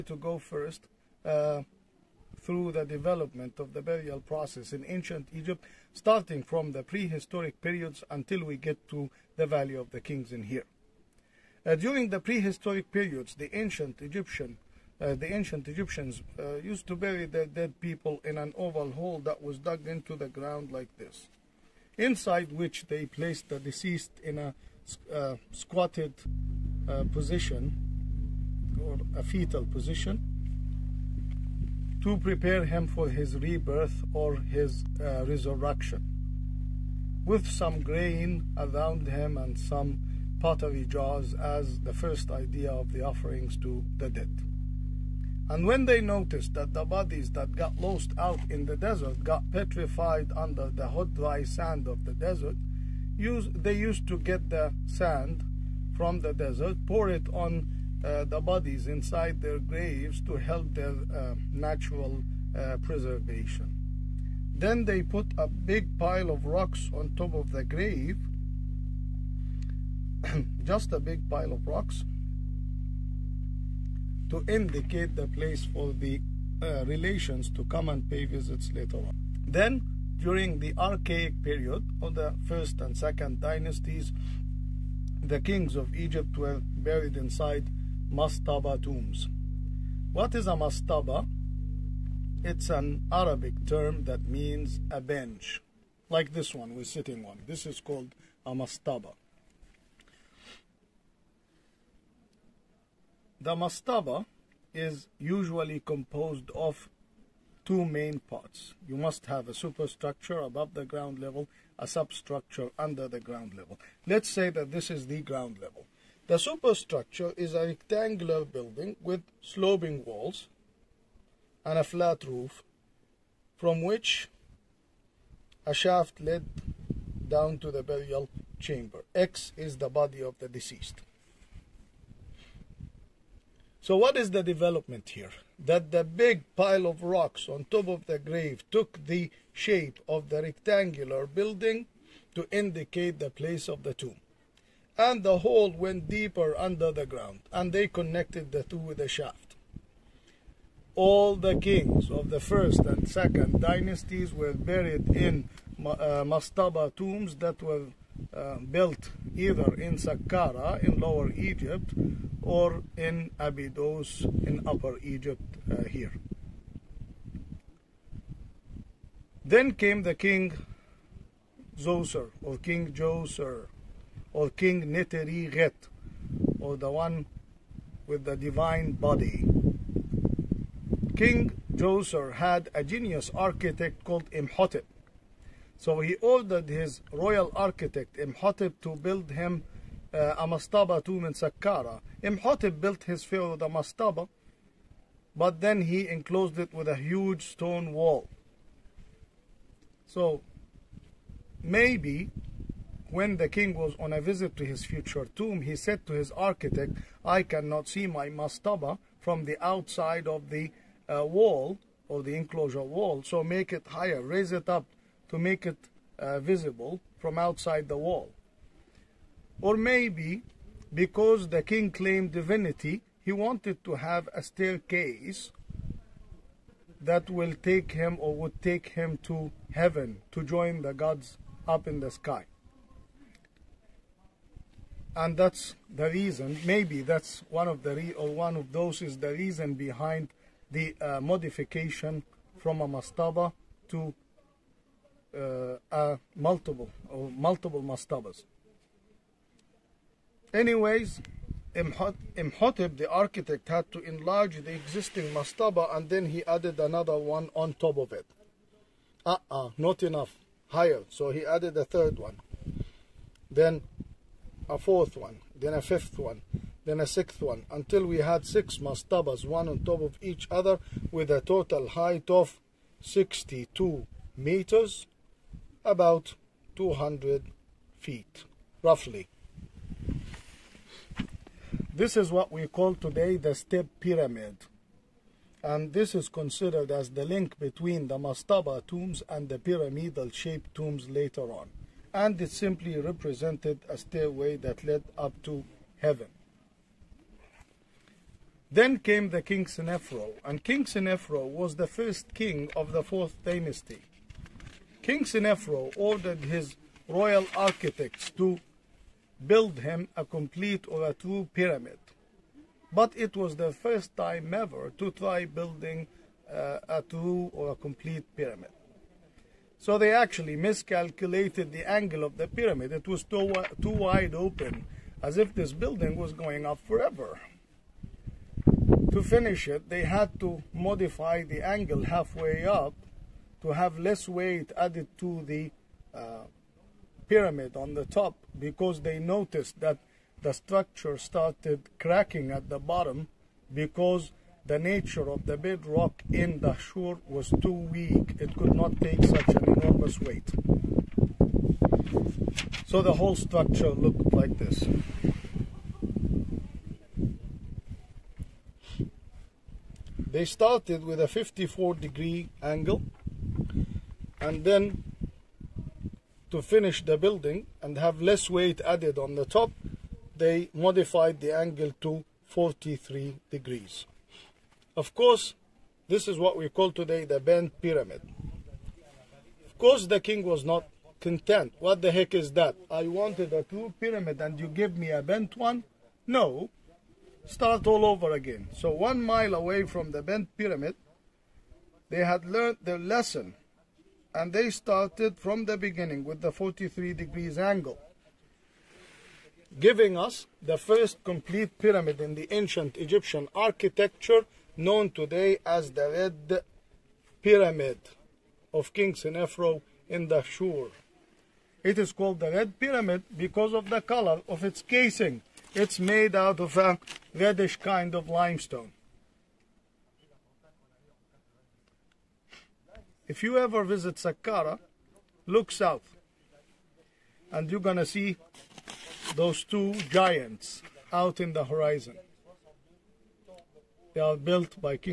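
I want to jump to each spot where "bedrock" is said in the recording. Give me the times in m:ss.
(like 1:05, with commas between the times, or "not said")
5:45.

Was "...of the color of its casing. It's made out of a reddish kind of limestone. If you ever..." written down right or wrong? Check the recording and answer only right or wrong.
right.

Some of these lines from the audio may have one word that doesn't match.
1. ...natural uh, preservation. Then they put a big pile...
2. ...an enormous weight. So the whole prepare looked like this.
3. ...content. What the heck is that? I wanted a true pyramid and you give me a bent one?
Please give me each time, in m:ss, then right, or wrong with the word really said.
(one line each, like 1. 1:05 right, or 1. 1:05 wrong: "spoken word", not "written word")
1. 1:01 right
2. 5:49 wrong: "structure", not "prepare"
3. 6:21 right.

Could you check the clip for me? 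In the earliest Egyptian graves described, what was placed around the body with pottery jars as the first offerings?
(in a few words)
Grain.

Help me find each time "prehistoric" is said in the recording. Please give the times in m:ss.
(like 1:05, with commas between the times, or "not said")
0:06, 0:12.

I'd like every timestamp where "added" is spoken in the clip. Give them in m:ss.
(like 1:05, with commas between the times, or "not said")
4:16, 4:21, 5:34, 6:08.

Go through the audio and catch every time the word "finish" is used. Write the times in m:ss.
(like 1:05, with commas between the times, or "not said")
5:29, 6:06.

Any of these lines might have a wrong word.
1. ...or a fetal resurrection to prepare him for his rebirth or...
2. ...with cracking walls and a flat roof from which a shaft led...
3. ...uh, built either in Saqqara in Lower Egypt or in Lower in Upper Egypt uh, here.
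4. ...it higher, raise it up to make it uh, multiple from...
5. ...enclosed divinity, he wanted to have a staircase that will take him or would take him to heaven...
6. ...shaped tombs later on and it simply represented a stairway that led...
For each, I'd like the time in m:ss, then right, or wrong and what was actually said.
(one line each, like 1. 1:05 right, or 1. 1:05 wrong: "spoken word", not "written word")
1. 0:28 wrong: "position", not "resurrection"
2. 1:59 wrong: "sloping", not "cracking"
3. 2:38 wrong: "Abydos", not "Lower"
4. 3:33 wrong: "visible", not "multiple"
5. 3:41 wrong: "claimed", not "enclosed"
6. 4:50 right.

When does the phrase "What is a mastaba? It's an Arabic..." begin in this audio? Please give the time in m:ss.
1:30.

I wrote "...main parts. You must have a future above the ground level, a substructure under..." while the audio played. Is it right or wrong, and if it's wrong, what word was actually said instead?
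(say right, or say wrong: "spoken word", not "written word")
wrong: "superstructure", not "future".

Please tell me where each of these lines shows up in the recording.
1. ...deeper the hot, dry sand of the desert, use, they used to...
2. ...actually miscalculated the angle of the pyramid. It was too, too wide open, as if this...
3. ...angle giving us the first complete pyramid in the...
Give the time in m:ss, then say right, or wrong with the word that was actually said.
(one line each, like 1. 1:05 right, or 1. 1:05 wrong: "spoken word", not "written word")
1. 0:50 wrong: "under", not "deeper"
2. 5:20 right
3. 6:37 right.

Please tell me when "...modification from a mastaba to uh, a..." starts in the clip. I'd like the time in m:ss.
4:01.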